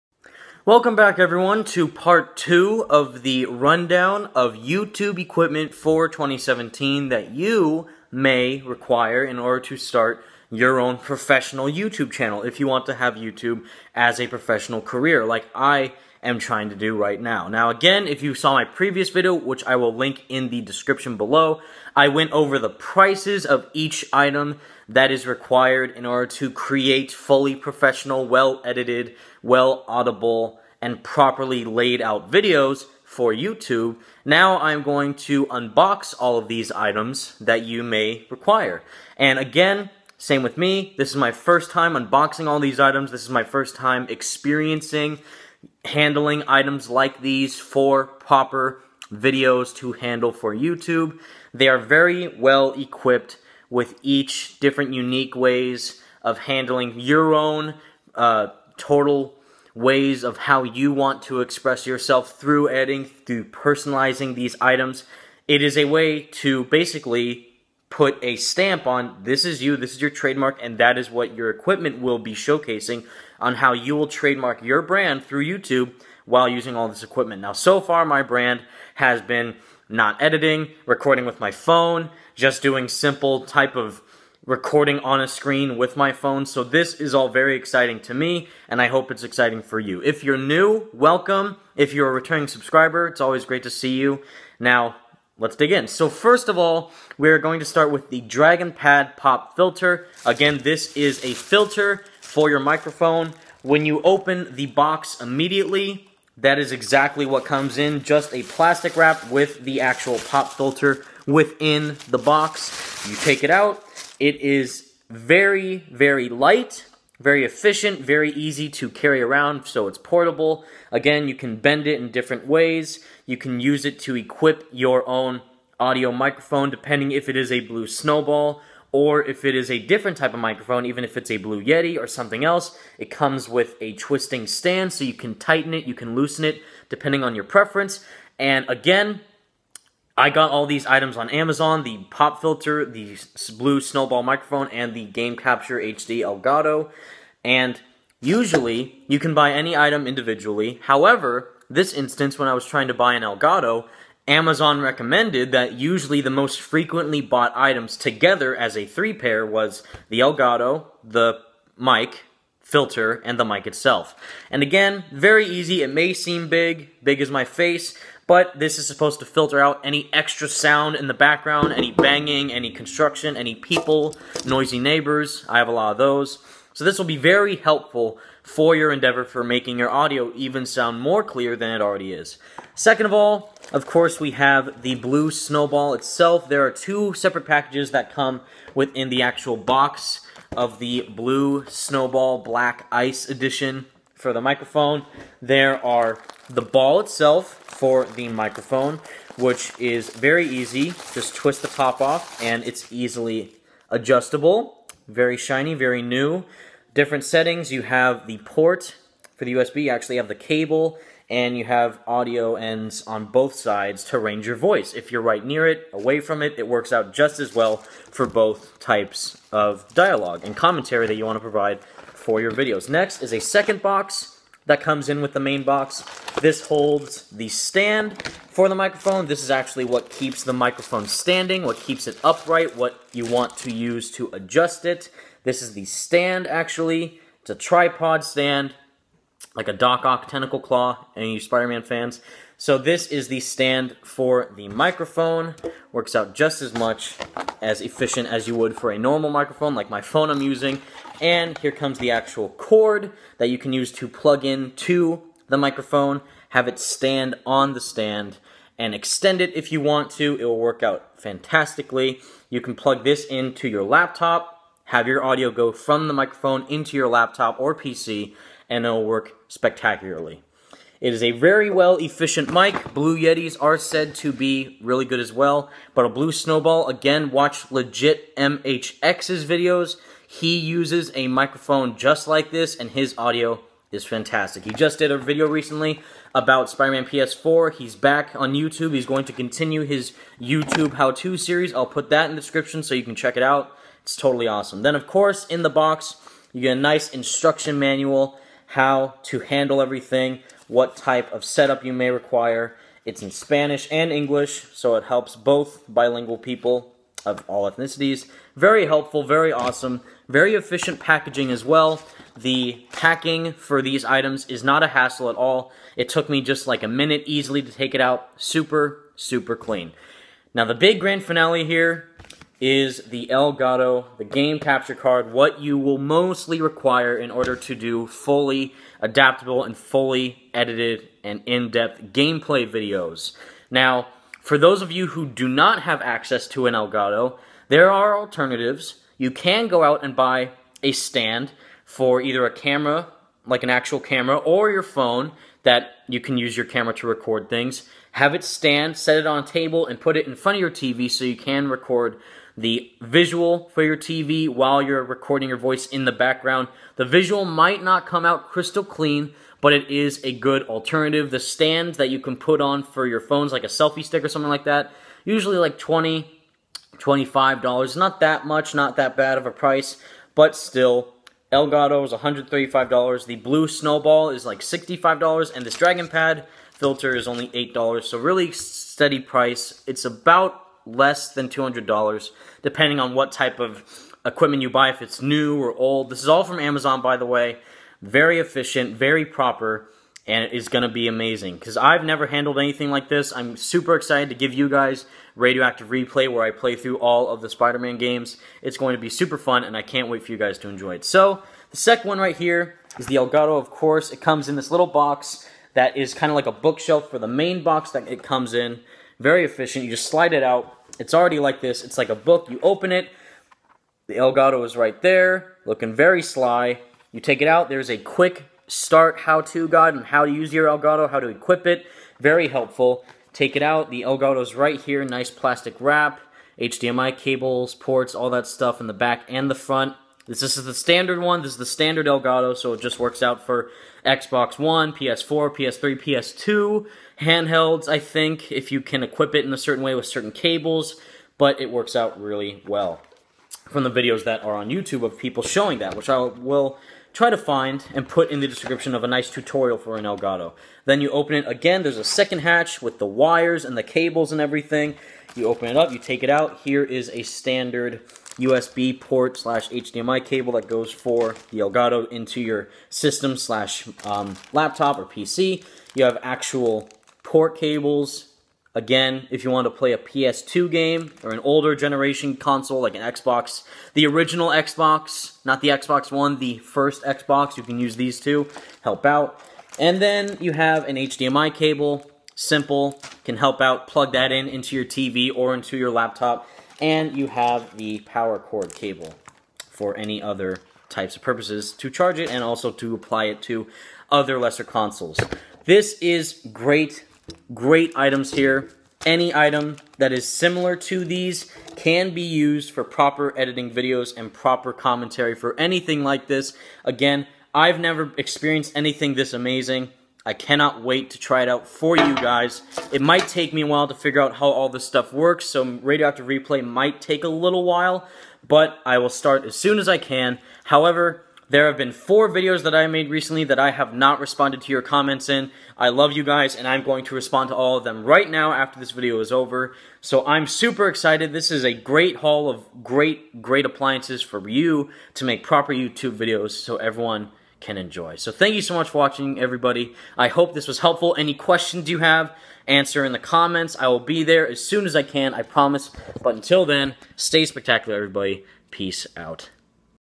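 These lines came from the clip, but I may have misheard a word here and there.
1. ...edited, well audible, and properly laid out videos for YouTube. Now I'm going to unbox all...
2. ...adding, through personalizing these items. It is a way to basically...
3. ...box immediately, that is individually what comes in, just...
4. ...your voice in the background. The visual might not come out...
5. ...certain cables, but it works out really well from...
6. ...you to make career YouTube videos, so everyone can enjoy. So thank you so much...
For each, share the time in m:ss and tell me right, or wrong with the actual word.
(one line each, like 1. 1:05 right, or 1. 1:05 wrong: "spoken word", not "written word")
1. 0:28 right
2. 1:02 right
3. 1:44 wrong: "exactly", not "individually"
4. 5:55 right
5. 7:20 right
6. 8:54 wrong: "proper", not "career".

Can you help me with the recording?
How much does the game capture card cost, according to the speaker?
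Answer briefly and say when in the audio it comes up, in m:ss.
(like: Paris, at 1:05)
$135, at 6:12.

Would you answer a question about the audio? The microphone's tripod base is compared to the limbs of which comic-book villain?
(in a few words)
Doc Ock.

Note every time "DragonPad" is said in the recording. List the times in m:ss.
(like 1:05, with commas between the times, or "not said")
1:38, 6:15.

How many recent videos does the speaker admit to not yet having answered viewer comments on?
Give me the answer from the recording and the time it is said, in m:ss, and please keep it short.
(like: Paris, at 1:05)
4, at 8:41.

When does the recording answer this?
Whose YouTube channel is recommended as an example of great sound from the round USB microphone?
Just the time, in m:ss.
4:37.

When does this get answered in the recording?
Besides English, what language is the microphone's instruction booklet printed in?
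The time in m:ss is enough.
5:03.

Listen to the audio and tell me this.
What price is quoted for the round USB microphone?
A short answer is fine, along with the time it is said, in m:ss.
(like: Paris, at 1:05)
$65, at 6:14.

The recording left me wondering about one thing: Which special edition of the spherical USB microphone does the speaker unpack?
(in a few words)
Black Ice Edition.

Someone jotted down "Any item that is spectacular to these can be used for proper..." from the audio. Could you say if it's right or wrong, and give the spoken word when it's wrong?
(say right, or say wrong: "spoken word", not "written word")
wrong: "similar", not "spectacular".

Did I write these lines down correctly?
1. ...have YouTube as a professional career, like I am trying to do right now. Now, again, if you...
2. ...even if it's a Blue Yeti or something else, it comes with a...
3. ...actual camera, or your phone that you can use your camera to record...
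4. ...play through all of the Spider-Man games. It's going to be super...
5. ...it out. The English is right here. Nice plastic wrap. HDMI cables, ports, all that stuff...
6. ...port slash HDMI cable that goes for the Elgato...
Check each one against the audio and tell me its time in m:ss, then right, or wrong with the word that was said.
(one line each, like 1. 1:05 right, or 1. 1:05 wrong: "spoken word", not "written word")
1. 0:12 right
2. 2:10 right
3. 5:43 right
4. 6:36 right
5. 7:03 wrong: "Elgato", not "English"
6. 7:38 right.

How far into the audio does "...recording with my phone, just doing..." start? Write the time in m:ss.
1:20.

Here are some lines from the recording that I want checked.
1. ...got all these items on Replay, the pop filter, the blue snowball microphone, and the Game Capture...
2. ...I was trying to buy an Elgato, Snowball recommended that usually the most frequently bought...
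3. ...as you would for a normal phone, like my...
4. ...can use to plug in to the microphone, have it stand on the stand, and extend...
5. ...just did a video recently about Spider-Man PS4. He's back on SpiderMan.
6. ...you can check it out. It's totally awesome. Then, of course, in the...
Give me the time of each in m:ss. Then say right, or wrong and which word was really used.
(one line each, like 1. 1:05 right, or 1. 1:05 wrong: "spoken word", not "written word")
1. 2:20 wrong: "Amazon", not "Replay"
2. 2:32 wrong: "Amazon", not "Snowball"
3. 4:08 wrong: "microphone", not "phone"
4. 4:13 right
5. 4:44 wrong: "YouTube", not "SpiderMan"
6. 4:52 right.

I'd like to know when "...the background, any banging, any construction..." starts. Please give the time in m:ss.
2:51.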